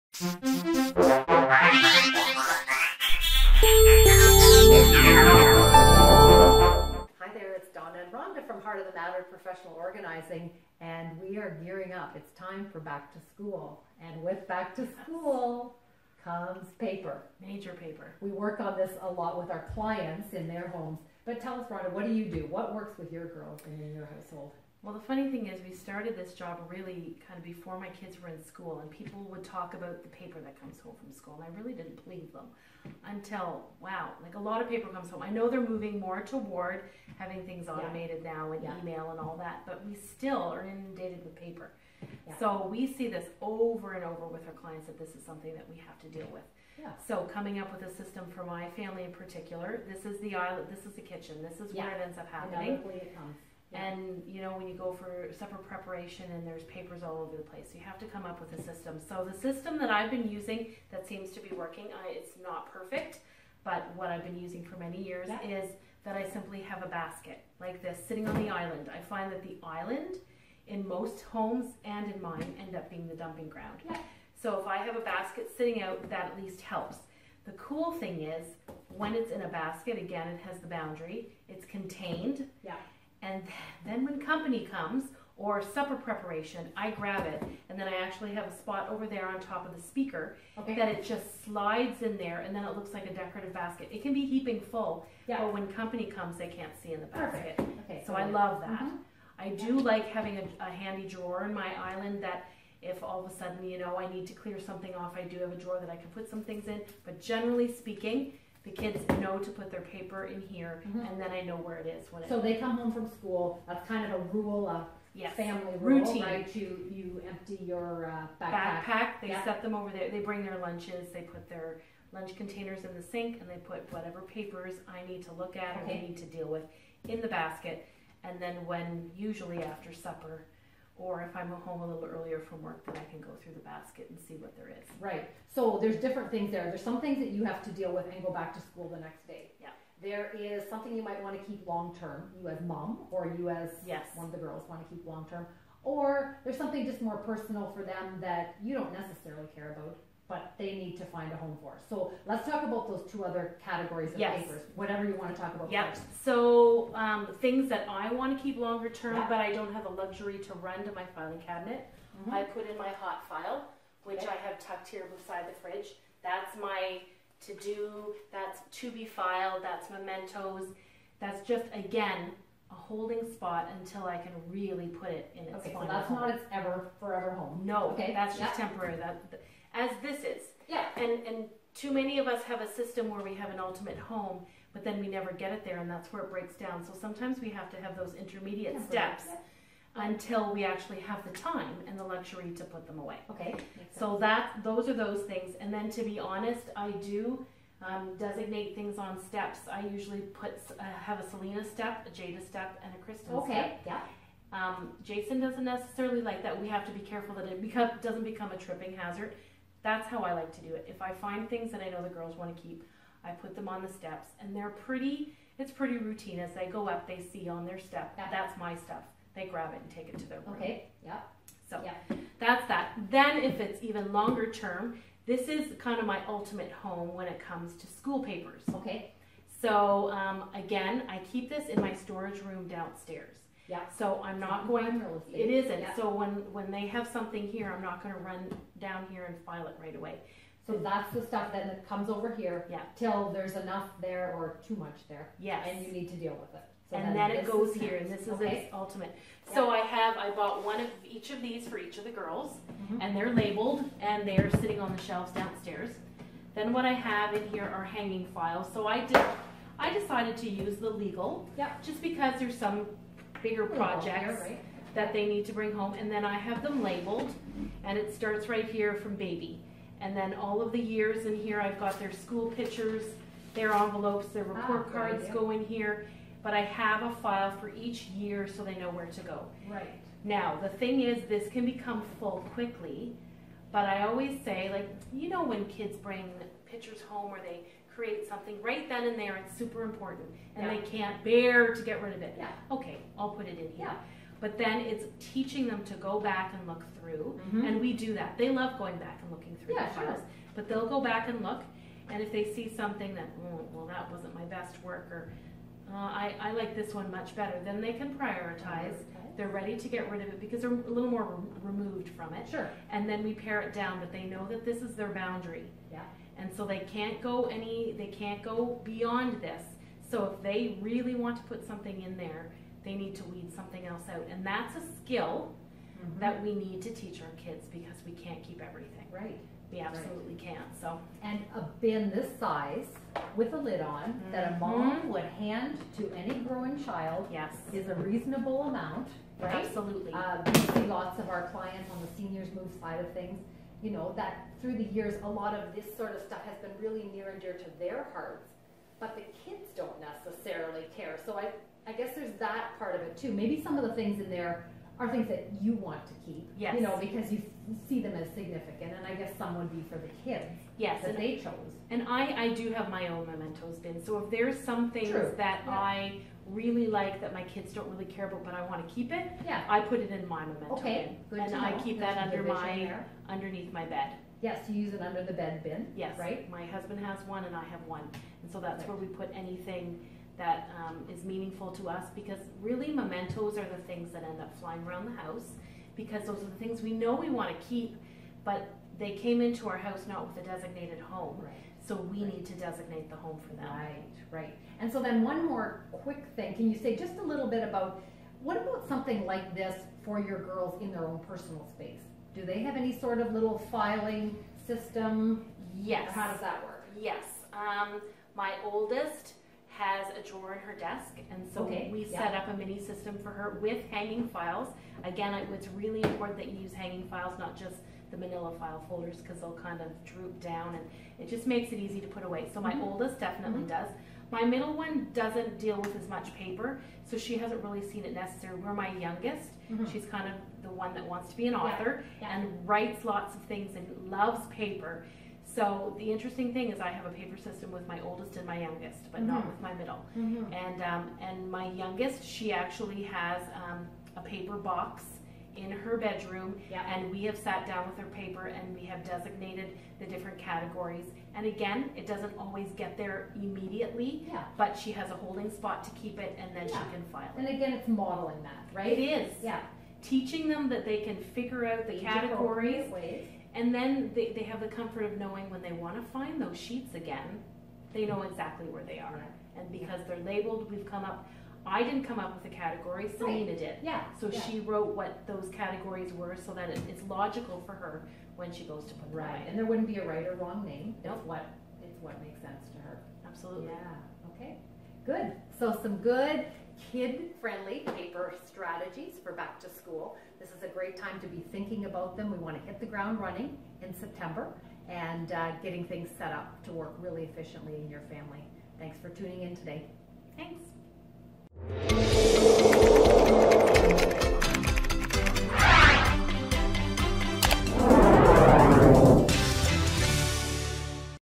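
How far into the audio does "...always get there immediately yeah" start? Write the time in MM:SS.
07:32.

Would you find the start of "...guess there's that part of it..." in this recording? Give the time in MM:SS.
05:51.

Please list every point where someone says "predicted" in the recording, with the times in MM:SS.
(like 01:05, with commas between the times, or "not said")
not said.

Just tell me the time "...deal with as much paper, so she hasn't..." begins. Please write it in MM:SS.
07:05.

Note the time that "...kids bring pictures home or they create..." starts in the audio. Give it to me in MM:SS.
04:45.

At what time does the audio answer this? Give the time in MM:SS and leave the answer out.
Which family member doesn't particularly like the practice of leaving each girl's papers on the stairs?
03:25.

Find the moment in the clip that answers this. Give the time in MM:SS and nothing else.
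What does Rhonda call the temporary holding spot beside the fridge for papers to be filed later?
02:42.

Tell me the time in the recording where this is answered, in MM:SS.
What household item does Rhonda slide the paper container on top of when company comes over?
01:29.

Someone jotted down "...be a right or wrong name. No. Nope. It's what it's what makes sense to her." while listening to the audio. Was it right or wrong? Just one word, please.
right.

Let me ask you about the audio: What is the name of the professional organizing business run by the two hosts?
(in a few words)
Heart of the Matter.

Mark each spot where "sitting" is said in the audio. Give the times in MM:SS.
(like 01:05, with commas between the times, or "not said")
01:08, 01:15, 04:14.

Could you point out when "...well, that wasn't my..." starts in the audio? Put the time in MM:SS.
05:03.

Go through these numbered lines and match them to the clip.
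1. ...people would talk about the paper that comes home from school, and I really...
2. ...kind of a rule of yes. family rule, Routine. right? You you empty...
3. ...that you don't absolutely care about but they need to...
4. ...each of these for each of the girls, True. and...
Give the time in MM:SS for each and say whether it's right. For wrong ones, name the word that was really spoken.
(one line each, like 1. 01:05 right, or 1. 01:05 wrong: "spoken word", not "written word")
1. 00:28 right
2. 01:53 right
3. 02:28 wrong: "necessarily", not "absolutely"
4. 04:11 wrong: "Mhm", not "True".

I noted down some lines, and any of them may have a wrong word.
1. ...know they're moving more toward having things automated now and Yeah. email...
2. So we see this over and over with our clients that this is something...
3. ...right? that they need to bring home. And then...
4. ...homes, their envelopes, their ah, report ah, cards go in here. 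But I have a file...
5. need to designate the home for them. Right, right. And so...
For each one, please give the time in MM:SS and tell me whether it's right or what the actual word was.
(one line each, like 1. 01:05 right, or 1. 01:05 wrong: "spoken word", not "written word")
1. 00:35 right
2. 00:42 right
3. 04:24 right
4. 04:32 wrong: "pictures", not "homes"
5. 06:32 right.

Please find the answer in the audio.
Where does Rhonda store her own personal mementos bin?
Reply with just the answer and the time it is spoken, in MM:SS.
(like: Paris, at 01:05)
Under the bed, at 06:13.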